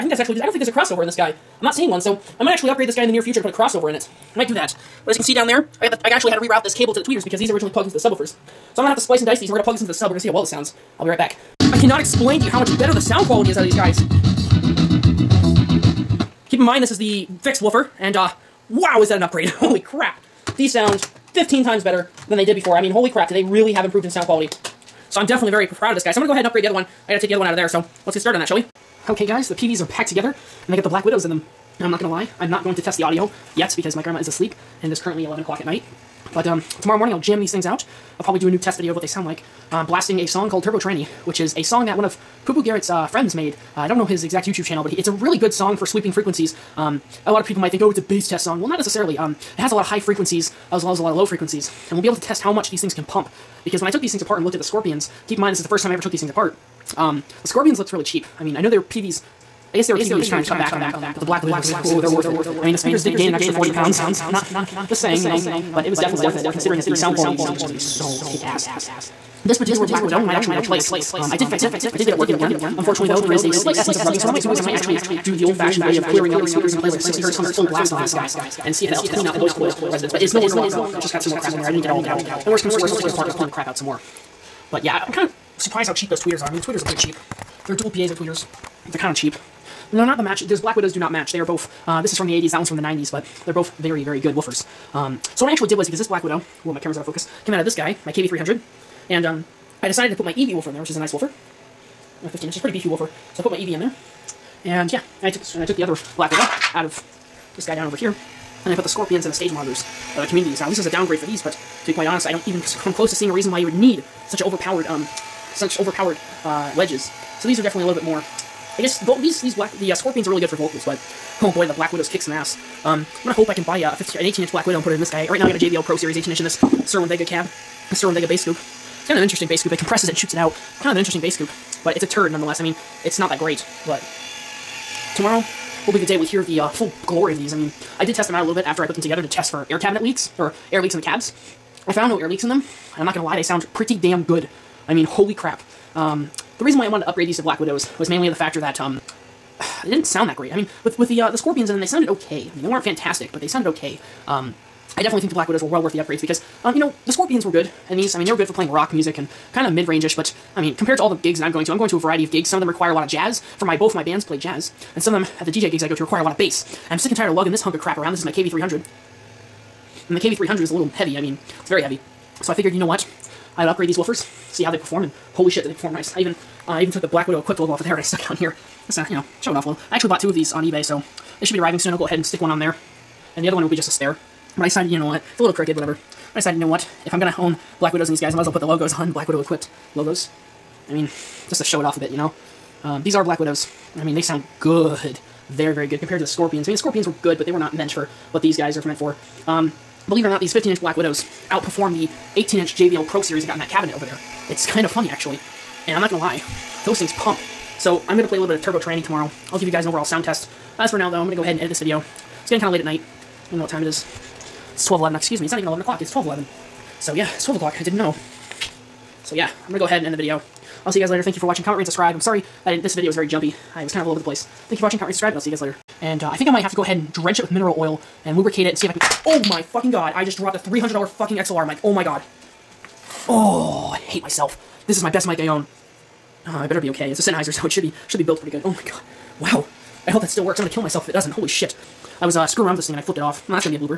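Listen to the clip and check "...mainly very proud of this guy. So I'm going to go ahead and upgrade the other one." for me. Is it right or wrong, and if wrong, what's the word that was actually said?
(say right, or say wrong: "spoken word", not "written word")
wrong: "definitely", not "mainly".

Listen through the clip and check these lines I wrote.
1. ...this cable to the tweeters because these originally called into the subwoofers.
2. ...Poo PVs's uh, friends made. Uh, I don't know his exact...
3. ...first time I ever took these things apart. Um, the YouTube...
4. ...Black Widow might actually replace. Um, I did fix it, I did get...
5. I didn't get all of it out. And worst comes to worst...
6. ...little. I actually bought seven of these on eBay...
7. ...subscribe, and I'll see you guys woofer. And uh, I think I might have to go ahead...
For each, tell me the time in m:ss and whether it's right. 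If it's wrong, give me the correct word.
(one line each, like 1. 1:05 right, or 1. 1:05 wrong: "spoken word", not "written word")
1. 0:06 wrong: "plugged", not "called"
2. 0:42 wrong: "Garrett", not "PVs"
3. 0:55 wrong: "Scorpions", not "YouTube"
4. 1:09 right
5. 1:21 right
6. 2:59 wrong: "two", not "seven"
7. 3:45 wrong: "later", not "woofer".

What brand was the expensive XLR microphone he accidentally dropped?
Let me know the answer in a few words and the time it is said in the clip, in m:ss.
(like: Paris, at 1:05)
Sennheiser, at 3:57.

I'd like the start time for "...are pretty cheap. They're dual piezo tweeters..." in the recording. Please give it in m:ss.
1:26.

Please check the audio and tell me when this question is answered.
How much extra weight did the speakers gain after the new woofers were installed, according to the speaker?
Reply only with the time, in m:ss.
1:03.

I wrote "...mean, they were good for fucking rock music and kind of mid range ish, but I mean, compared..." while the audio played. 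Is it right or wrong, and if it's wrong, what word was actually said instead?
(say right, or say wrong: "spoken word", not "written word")
wrong: "playing", not "fucking".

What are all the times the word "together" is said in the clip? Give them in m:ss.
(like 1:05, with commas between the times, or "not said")
0:30, 2:19.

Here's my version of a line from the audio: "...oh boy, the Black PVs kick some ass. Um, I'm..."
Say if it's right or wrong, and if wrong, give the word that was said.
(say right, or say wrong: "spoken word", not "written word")
wrong: "Widows", not "PVs".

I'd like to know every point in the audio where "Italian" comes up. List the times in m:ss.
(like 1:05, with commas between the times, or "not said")
not said.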